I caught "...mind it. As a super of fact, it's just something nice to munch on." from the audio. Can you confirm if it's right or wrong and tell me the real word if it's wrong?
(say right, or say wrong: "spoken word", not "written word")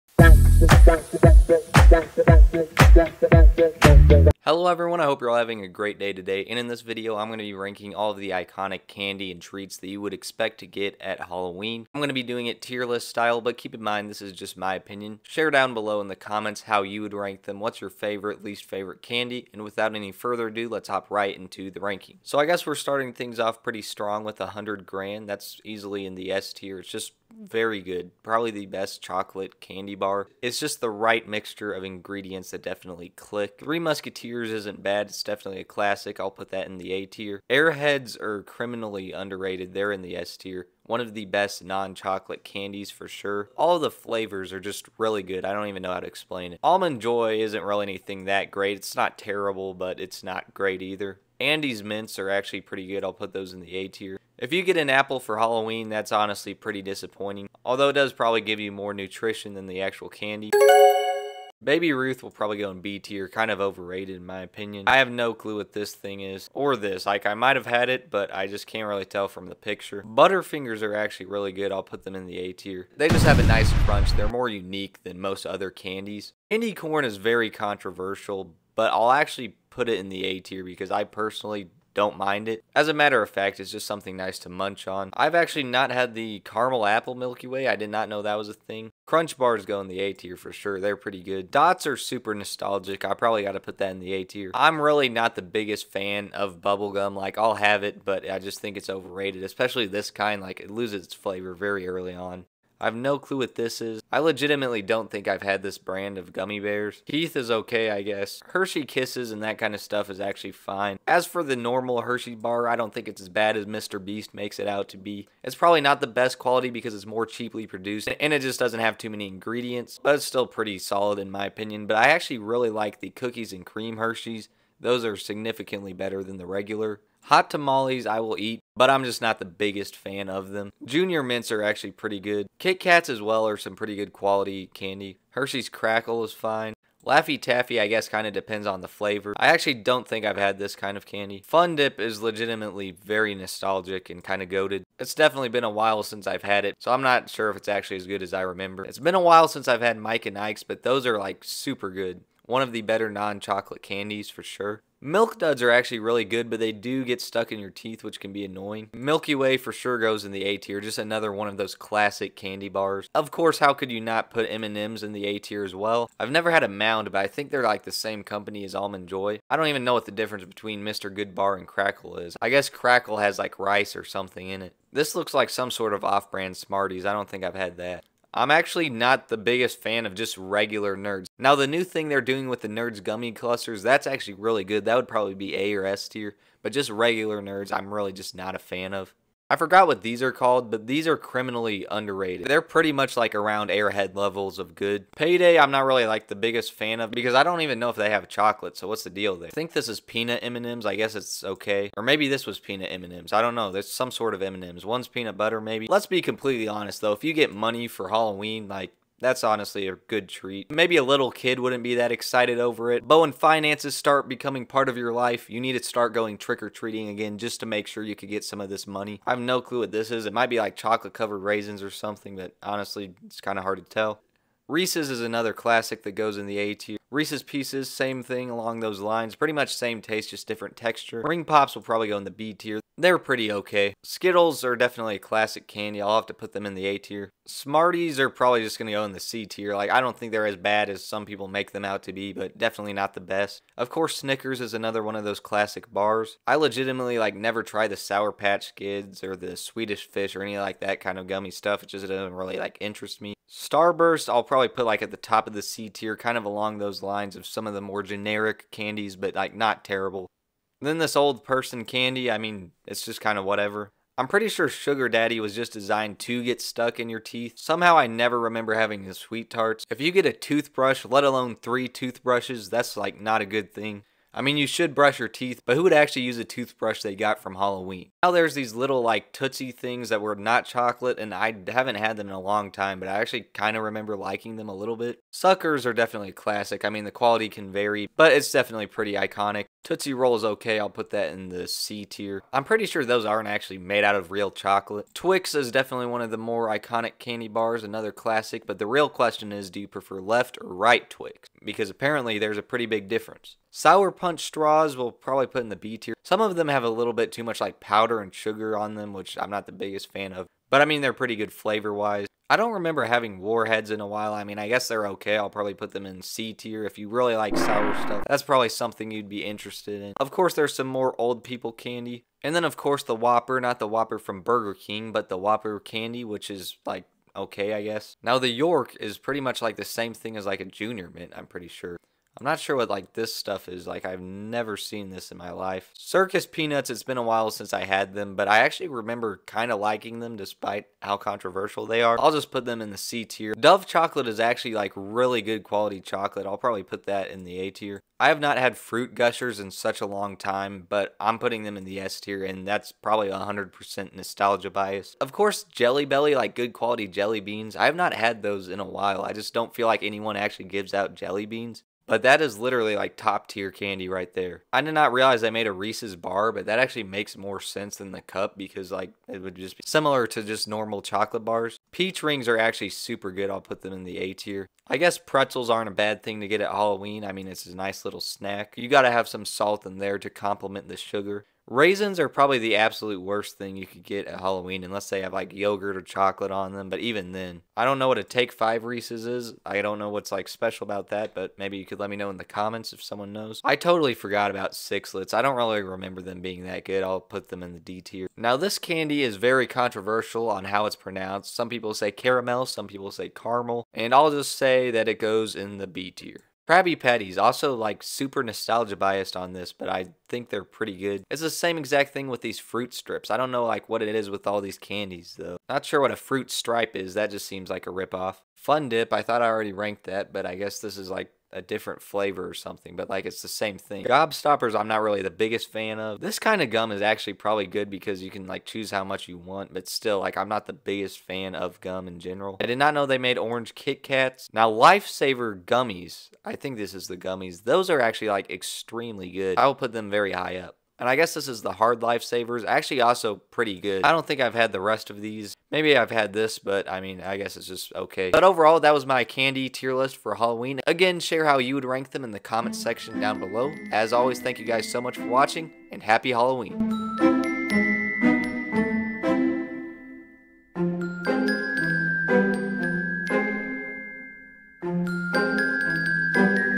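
wrong: "matter", not "super".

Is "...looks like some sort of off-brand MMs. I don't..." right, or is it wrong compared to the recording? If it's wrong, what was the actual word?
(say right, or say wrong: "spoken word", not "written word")
wrong: "Smarties", not "MMs".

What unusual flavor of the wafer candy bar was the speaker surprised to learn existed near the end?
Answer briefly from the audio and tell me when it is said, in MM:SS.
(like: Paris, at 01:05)
Orange, at 07:13.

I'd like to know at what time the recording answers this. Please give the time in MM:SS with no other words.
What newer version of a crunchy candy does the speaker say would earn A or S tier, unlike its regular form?
03:02.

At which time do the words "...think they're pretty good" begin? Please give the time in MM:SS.
06:50.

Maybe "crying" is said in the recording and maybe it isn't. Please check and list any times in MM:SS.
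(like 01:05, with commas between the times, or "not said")
not said.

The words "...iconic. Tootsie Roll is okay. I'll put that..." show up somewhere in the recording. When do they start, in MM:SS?
04:49.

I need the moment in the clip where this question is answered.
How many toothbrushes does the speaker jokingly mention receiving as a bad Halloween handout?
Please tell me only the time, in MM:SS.
04:31.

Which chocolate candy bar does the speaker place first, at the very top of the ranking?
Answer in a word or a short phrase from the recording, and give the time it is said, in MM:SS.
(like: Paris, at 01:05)
100 Grand, at 00:24.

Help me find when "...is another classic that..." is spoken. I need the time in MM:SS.
03:45.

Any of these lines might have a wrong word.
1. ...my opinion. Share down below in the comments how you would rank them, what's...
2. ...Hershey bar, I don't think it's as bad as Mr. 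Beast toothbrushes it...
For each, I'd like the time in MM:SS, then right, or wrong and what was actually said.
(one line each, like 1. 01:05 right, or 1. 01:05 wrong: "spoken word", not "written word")
1. 00:14 right
2. 01:52 wrong: "makes", not "toothbrushes".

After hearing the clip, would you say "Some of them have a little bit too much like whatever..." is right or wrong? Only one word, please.
wrong.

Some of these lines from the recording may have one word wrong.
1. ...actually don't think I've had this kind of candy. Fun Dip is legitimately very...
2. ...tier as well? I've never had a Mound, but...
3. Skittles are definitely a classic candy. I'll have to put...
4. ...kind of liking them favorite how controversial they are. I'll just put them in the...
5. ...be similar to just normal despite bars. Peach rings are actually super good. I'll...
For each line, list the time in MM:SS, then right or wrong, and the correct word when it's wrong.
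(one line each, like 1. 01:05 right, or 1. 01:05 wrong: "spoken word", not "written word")
1. 02:19 right
2. 02:45 right
3. 03:54 right
4. 05:39 wrong: "despite", not "favorite"
5. 06:09 wrong: "chocolate", not "despite".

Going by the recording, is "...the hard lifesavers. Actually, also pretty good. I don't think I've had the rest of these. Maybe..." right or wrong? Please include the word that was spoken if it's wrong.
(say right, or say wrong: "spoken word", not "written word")
right.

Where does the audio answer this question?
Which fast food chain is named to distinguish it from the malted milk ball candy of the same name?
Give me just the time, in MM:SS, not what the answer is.
05:24.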